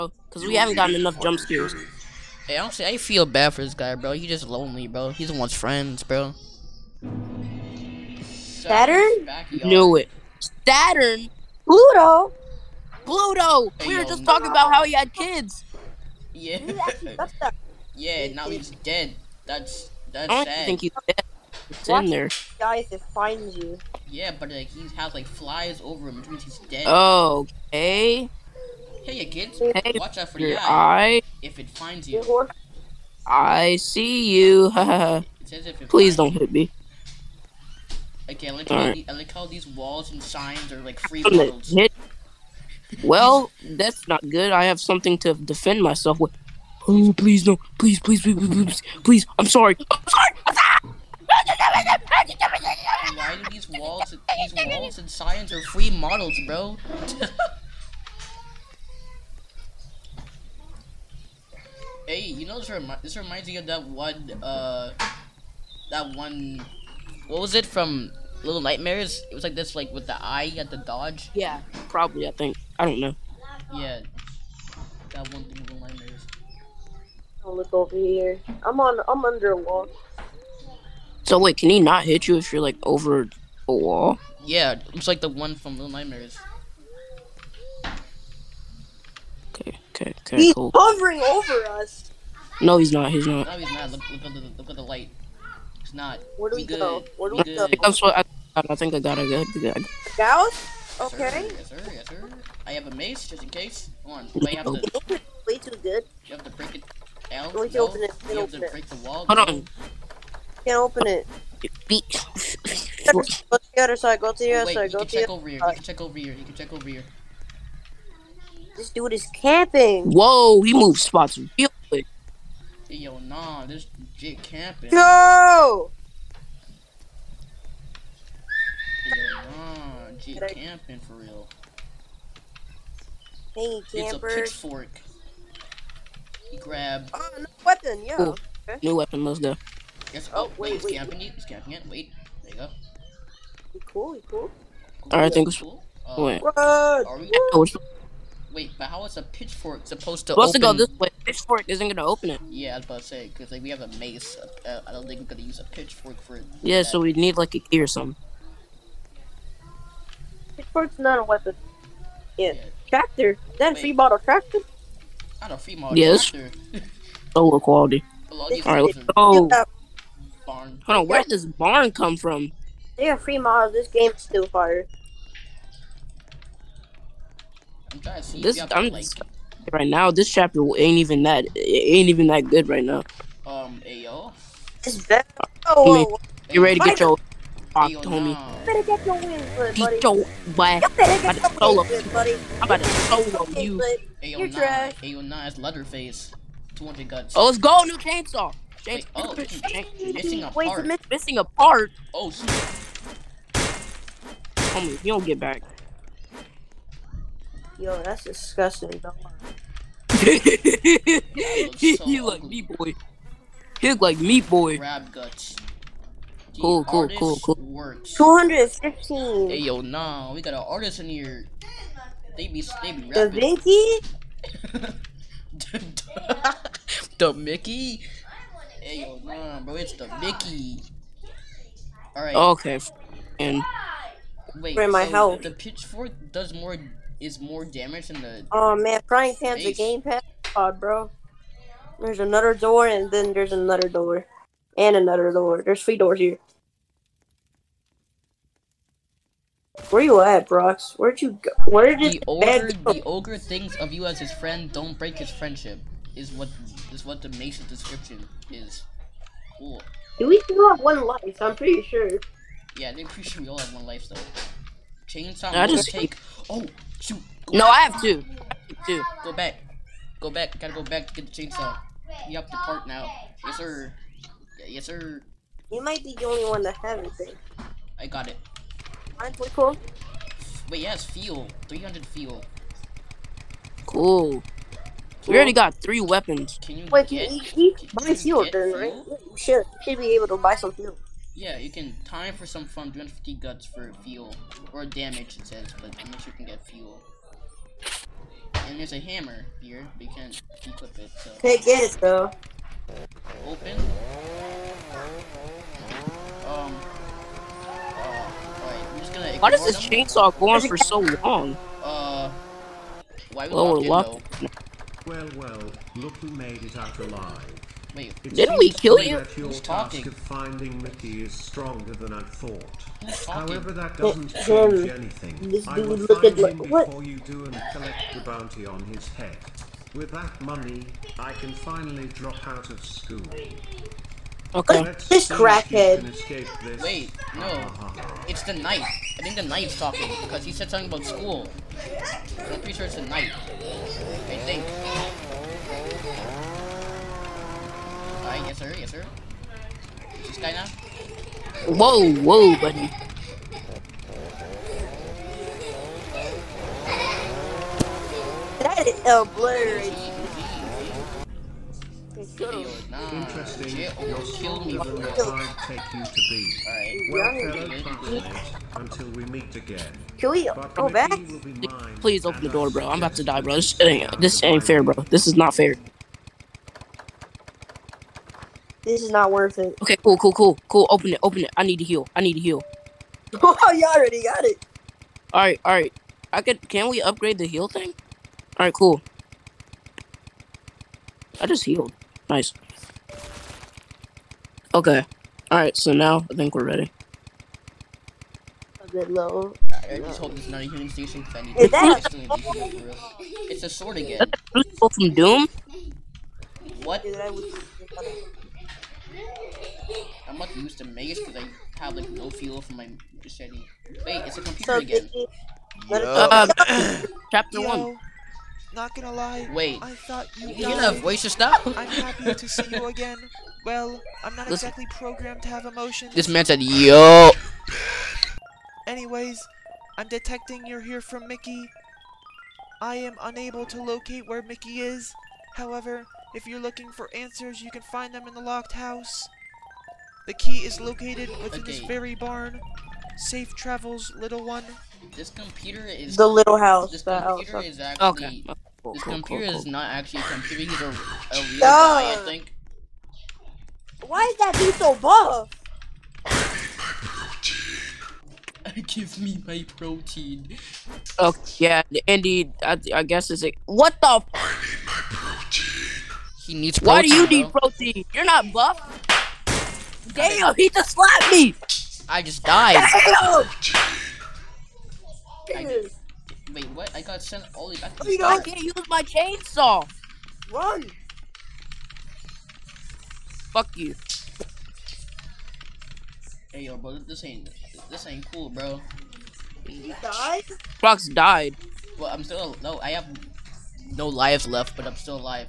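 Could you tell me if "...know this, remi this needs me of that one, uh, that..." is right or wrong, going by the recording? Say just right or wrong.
wrong.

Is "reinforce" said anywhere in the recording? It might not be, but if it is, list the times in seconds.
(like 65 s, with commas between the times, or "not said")
not said.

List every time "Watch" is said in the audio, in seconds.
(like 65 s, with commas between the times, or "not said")
21 s, 29 s.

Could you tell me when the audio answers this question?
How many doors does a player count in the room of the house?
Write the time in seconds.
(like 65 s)
245 s.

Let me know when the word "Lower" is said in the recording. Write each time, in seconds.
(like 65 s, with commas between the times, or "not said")
167 s, 313 s.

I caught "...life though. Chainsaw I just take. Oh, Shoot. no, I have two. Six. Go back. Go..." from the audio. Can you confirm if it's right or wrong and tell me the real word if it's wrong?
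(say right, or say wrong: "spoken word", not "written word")
wrong: "Two", not "Six".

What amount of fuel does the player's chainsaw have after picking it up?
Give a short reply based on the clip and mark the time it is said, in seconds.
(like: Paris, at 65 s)
300, at 281 s.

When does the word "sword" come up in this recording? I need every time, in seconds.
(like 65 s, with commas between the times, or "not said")
403 s.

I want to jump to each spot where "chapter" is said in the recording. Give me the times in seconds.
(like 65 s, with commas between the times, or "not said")
180 s, 417 s.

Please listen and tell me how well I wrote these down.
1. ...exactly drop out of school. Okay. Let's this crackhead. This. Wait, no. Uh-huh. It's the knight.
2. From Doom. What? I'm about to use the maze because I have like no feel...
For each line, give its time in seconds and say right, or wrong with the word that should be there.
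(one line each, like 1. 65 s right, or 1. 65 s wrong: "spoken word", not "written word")
1. 331 s wrong: "finally", not "exactly"
2. 404 s right.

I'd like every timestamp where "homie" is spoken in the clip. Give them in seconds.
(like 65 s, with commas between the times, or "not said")
187 s, 204 s.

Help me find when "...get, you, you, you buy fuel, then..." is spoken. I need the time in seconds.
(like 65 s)
287 s.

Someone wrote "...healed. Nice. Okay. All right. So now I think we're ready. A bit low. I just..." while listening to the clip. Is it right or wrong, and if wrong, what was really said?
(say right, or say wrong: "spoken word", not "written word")
right.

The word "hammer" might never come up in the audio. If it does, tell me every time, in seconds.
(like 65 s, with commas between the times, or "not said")
298 s.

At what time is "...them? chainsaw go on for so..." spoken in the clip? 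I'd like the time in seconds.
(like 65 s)
309 s.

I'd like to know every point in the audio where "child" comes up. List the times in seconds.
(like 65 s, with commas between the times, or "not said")
not said.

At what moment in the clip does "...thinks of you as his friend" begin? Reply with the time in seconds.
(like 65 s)
253 s.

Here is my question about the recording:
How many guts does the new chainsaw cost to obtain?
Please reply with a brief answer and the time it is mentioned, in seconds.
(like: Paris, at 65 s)
200, at 196 s.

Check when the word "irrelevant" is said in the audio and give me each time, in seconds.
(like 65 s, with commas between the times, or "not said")
not said.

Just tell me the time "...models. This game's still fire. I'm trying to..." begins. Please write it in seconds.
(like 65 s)
173 s.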